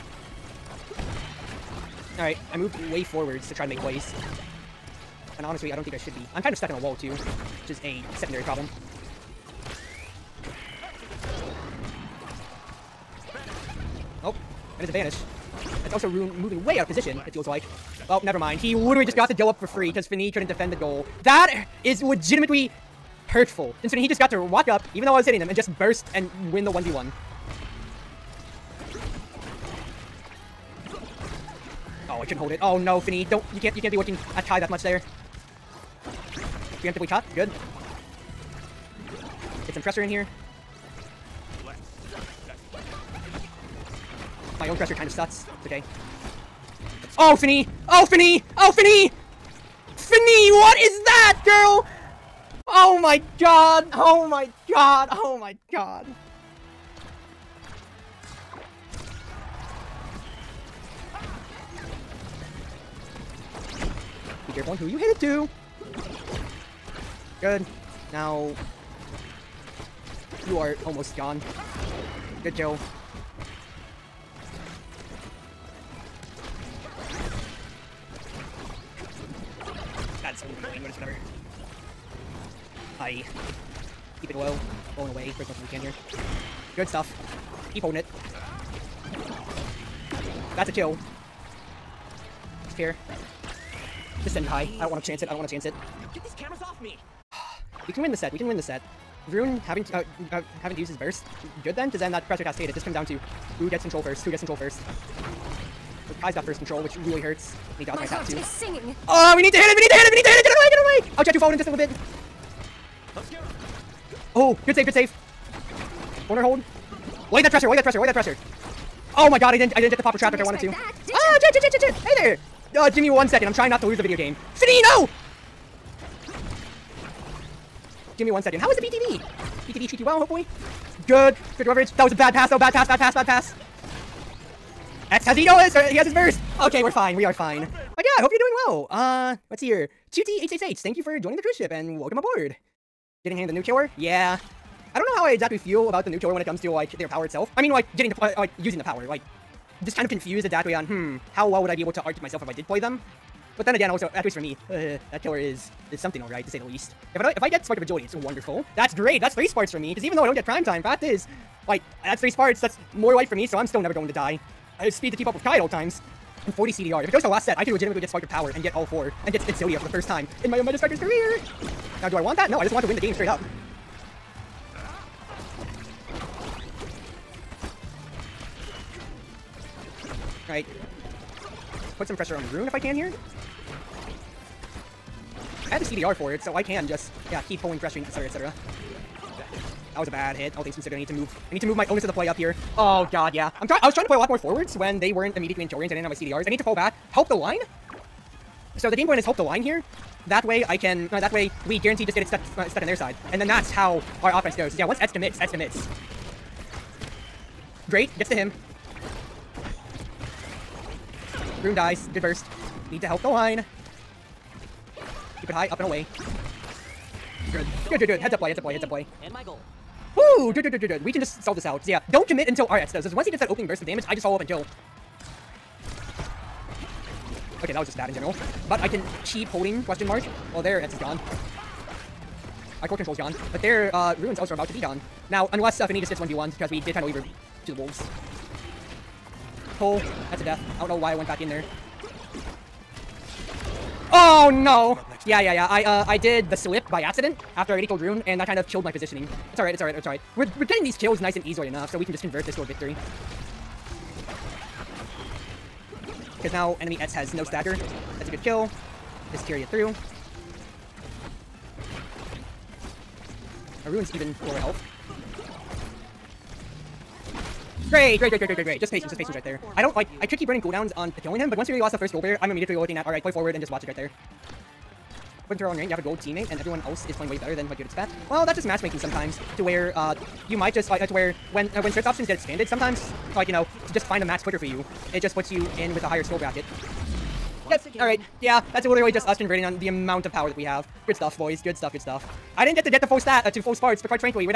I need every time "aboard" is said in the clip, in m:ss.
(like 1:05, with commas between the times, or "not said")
2:22.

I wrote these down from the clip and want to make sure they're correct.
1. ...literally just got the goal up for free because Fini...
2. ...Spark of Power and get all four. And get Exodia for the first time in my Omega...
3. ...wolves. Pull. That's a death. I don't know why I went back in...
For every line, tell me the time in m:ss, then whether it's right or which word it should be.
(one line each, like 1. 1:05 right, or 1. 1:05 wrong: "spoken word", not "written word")
1. 0:18 right
2. 2:48 right
3. 3:57 right.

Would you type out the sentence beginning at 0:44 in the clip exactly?
My own pressure kind of sucks.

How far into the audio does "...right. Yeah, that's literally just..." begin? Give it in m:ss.
4:48.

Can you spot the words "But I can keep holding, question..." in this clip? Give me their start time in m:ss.
3:48.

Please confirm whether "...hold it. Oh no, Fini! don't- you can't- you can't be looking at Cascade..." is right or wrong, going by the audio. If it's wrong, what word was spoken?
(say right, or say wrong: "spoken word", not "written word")
wrong: "Kai", not "Cascade".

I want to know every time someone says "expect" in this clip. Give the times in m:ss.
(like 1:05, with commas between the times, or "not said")
4:37.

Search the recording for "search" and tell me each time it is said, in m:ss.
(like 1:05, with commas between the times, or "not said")
4:41.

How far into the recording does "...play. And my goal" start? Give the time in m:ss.
3:38.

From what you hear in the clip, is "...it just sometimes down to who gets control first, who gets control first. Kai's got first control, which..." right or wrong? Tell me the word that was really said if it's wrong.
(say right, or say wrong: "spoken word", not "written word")
wrong: "comes", not "sometimes".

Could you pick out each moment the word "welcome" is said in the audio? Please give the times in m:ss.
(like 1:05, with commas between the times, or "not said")
2:21.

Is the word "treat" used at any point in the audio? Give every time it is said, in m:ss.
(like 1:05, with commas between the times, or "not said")
2:09.